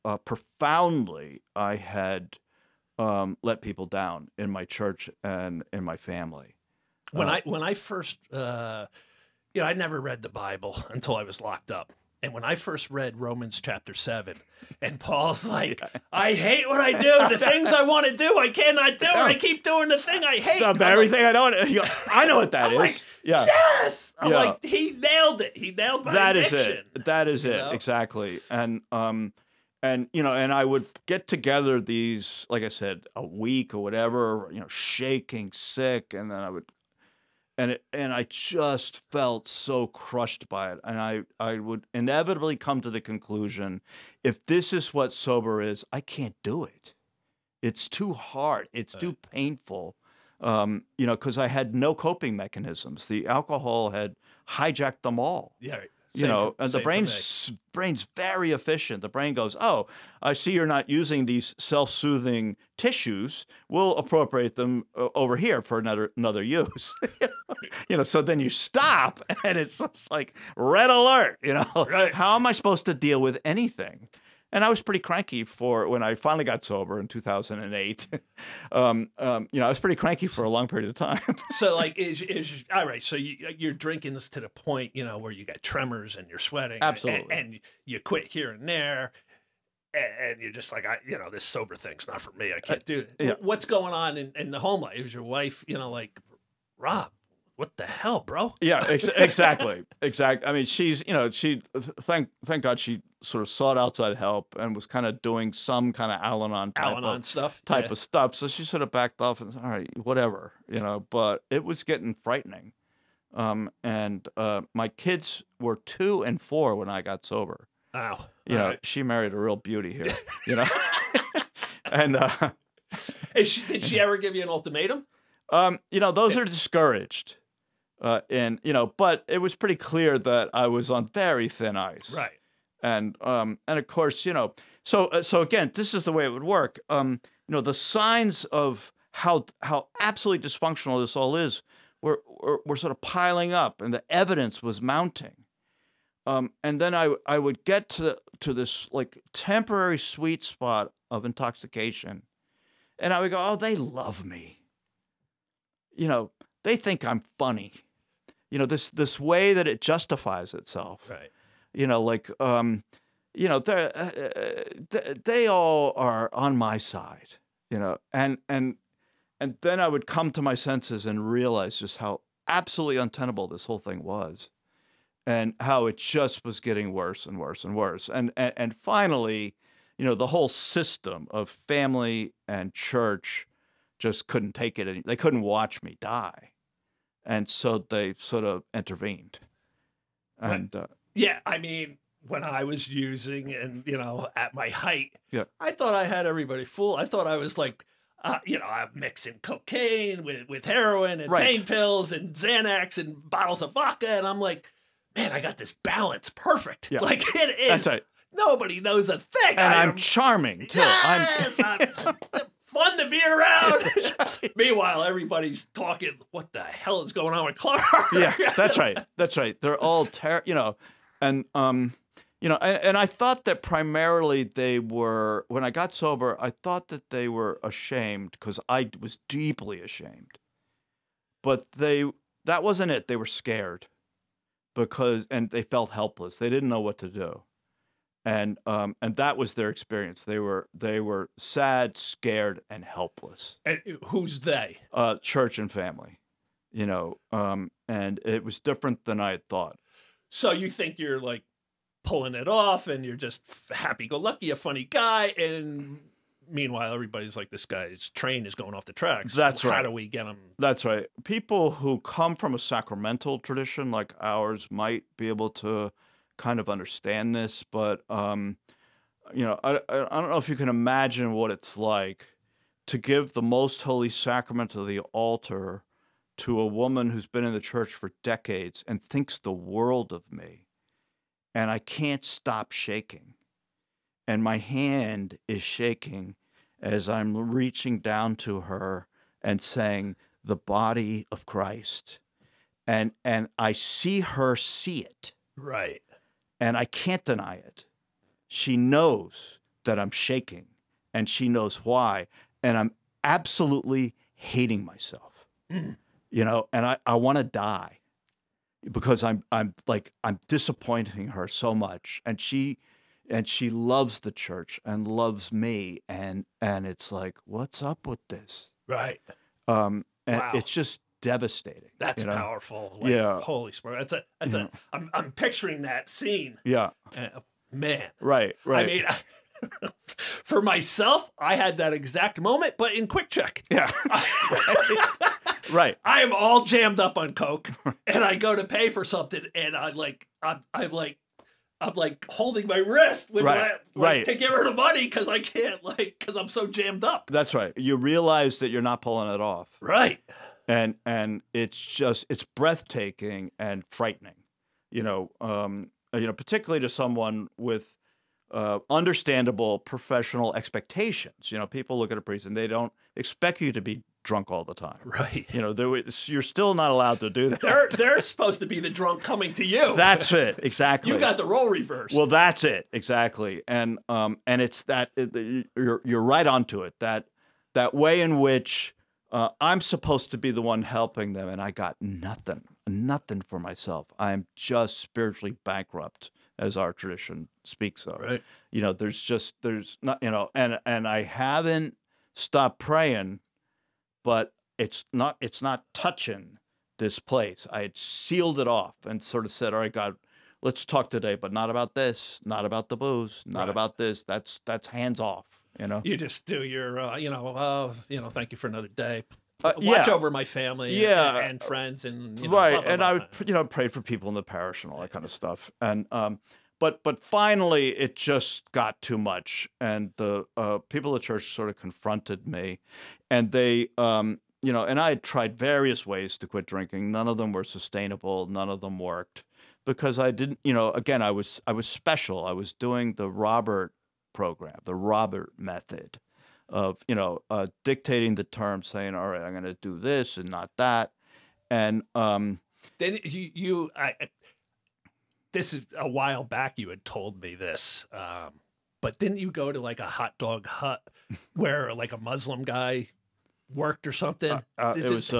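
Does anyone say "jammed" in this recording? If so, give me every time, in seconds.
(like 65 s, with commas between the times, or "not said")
336 s, 346 s.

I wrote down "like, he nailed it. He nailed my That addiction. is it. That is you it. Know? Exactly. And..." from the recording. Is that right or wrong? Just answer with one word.
right.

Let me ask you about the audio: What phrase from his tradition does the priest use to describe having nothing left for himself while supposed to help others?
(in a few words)
Spiritually bankrupt.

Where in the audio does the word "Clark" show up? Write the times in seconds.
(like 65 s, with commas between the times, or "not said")
217 s.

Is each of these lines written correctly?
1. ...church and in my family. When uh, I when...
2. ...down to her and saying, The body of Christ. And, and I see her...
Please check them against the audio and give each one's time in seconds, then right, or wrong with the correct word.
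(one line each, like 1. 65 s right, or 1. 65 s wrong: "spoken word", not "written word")
1. 4 s right
2. 287 s right.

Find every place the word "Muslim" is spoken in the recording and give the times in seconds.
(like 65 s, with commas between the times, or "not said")
452 s.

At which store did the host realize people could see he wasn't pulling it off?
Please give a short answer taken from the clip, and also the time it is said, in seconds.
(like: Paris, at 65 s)
QuickChek, at 333 s.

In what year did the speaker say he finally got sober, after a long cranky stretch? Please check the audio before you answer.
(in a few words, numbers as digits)
2008.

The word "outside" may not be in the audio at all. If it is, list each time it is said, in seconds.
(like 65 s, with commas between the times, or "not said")
103 s.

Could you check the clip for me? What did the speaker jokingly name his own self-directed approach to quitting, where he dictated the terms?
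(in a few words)
The Robert method.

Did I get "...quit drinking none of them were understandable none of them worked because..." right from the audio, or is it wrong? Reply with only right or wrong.
wrong.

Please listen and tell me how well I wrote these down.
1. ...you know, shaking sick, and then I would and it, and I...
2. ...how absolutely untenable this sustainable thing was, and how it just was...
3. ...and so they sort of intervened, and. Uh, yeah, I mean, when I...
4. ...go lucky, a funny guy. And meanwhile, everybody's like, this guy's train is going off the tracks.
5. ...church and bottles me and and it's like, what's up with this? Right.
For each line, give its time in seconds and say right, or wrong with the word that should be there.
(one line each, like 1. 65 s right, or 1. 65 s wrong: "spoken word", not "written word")
1. 34 s right
2. 171 s wrong: "whole", not "sustainable"
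3. 187 s right
4. 254 s right
5. 314 s wrong: "loves", not "bottles".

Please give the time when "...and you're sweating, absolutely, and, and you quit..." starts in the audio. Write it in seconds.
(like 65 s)
86 s.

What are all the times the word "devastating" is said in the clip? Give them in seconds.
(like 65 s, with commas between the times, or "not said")
321 s.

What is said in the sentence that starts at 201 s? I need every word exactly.
pain pills and Xanax and bottles of vodka, and I'm like, man, I got this balance perfect.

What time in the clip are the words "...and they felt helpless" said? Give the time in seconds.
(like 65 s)
235 s.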